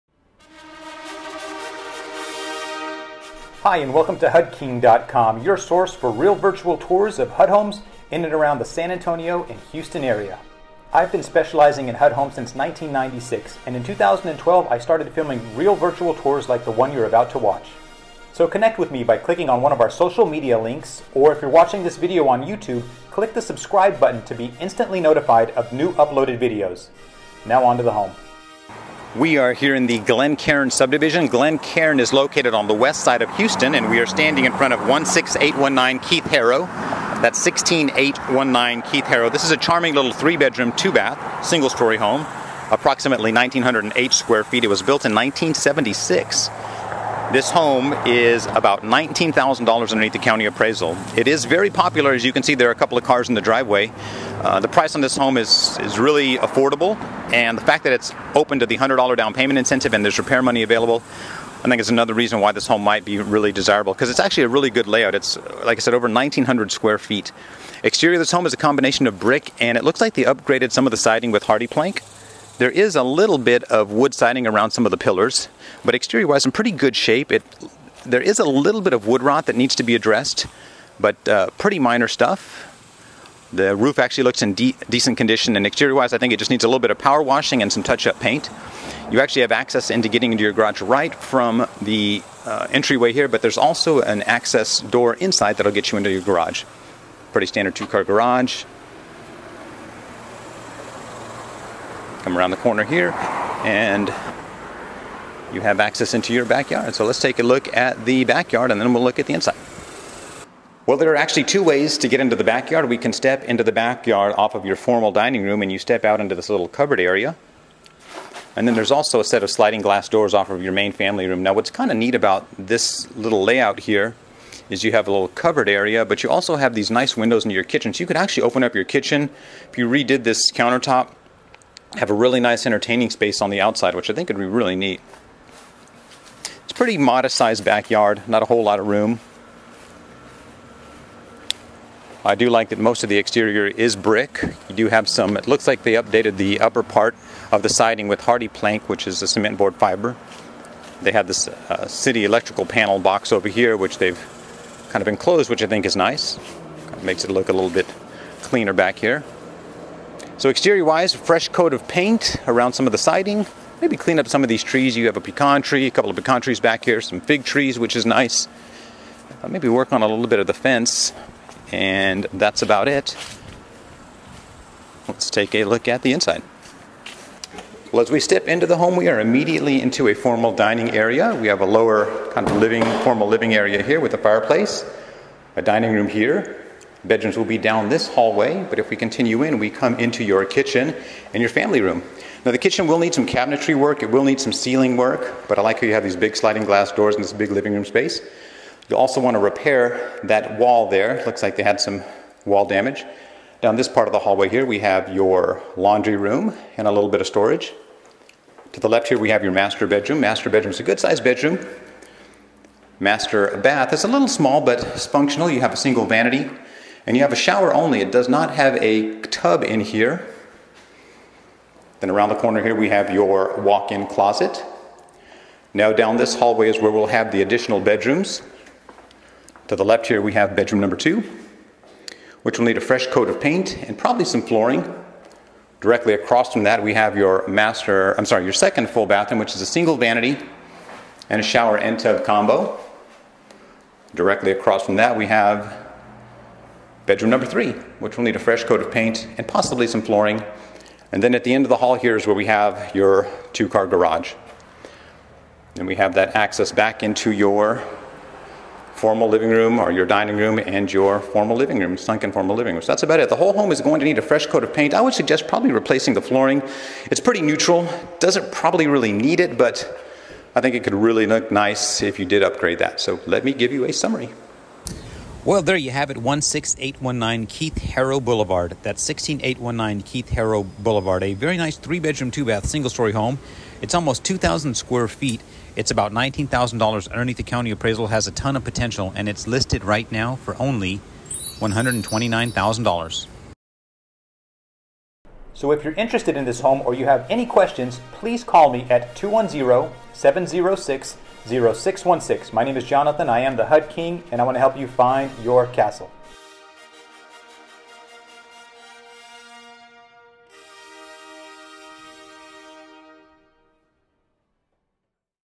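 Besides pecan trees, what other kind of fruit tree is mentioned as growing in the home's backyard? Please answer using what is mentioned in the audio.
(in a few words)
fig trees.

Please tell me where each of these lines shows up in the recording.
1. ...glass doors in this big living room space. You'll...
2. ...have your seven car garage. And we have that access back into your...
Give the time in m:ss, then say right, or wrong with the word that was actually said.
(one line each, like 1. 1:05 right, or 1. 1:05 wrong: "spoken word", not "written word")
1. 3:16 right
2. 4:12 wrong: "two", not "seven".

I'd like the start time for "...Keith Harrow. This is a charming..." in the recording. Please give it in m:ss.
0:38.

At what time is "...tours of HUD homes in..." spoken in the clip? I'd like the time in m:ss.
0:06.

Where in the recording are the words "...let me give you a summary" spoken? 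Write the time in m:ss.
4:33.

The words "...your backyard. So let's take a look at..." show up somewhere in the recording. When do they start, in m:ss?
1:46.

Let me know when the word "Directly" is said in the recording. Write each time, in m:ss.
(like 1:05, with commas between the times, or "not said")
3:55, 4:04.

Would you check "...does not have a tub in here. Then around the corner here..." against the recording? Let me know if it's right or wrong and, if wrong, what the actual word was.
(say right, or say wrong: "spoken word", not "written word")
right.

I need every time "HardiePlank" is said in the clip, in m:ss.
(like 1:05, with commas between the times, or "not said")
1:11, 2:28.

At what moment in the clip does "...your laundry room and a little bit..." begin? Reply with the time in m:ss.
3:25.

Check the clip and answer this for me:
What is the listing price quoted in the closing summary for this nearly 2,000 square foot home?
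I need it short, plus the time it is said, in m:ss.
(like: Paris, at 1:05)
$129,000, at 4:51.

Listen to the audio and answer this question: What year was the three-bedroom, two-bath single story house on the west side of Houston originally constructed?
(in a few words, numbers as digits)
1976.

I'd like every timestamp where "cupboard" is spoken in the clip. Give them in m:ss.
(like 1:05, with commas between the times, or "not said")
1:56, 2:05.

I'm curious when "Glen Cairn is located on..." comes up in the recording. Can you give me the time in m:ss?
0:31.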